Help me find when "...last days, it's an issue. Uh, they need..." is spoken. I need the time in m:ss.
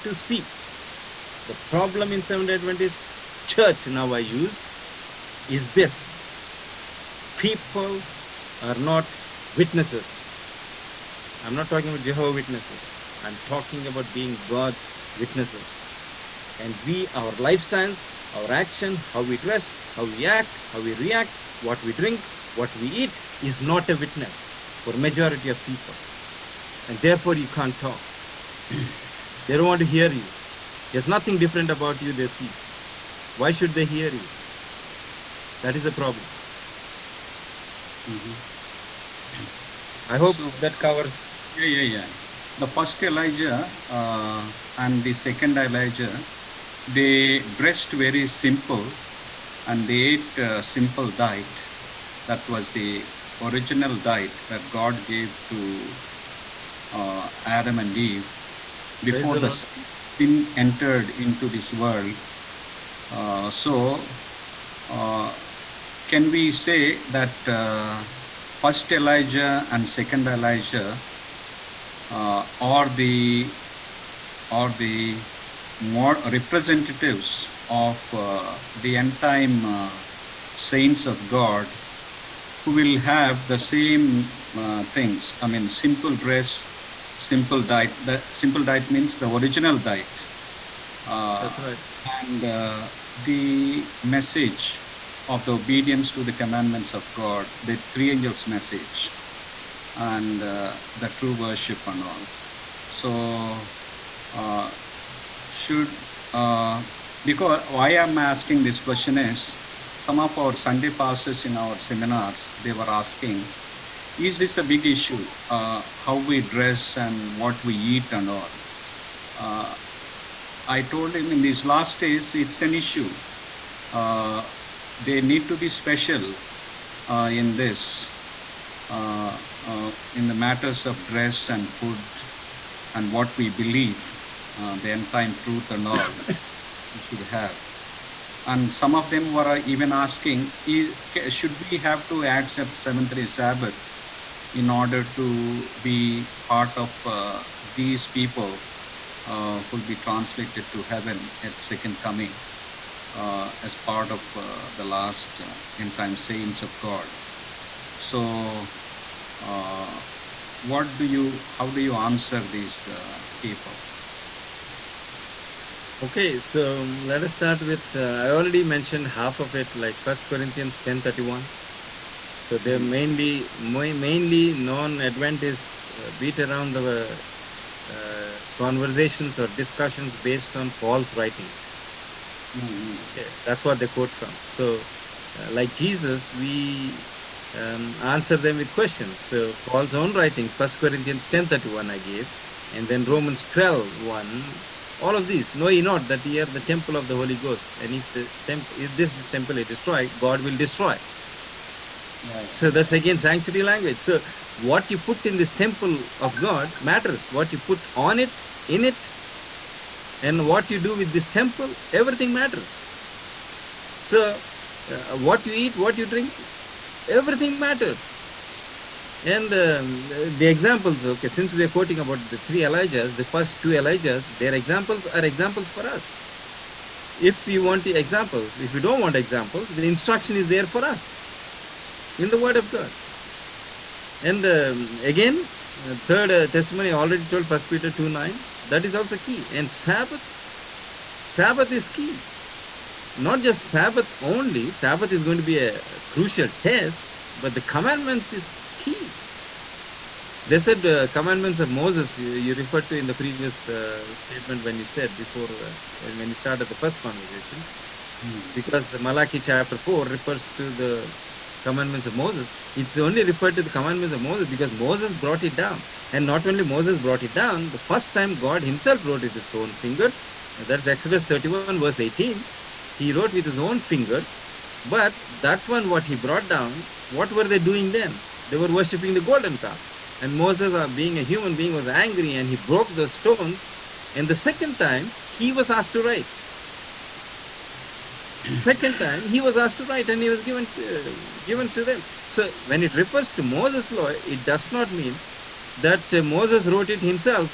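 2:01.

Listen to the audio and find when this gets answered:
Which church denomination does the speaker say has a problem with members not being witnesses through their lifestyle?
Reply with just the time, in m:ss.
0:02.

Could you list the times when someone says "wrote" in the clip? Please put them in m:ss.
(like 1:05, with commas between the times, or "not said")
4:29, 4:33, 4:56.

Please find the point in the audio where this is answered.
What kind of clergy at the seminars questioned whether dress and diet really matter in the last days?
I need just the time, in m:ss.
1:50.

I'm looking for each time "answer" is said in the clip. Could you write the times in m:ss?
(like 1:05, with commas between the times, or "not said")
2:41, 3:07.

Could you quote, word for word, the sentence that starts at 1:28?
The simple diet means the original diet.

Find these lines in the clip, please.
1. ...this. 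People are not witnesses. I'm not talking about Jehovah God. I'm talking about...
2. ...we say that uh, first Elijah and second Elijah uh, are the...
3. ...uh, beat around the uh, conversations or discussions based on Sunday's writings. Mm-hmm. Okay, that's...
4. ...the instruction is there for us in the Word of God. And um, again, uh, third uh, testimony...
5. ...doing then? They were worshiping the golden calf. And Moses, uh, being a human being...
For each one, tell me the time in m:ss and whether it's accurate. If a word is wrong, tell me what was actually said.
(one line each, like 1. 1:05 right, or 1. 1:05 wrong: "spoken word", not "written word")
1. 0:05 wrong: "Witnesses", not "God"
2. 1:06 right
3. 2:56 wrong: "Paul", not "Sunday"
4. 3:49 right
5. 4:37 right.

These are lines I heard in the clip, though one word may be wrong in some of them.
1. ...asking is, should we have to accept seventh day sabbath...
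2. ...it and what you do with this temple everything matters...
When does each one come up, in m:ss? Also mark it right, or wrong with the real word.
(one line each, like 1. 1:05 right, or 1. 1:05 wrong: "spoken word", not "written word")
1. 2:19 right
2. 3:28 right.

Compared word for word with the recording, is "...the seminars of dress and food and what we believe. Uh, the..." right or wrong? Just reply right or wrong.
wrong.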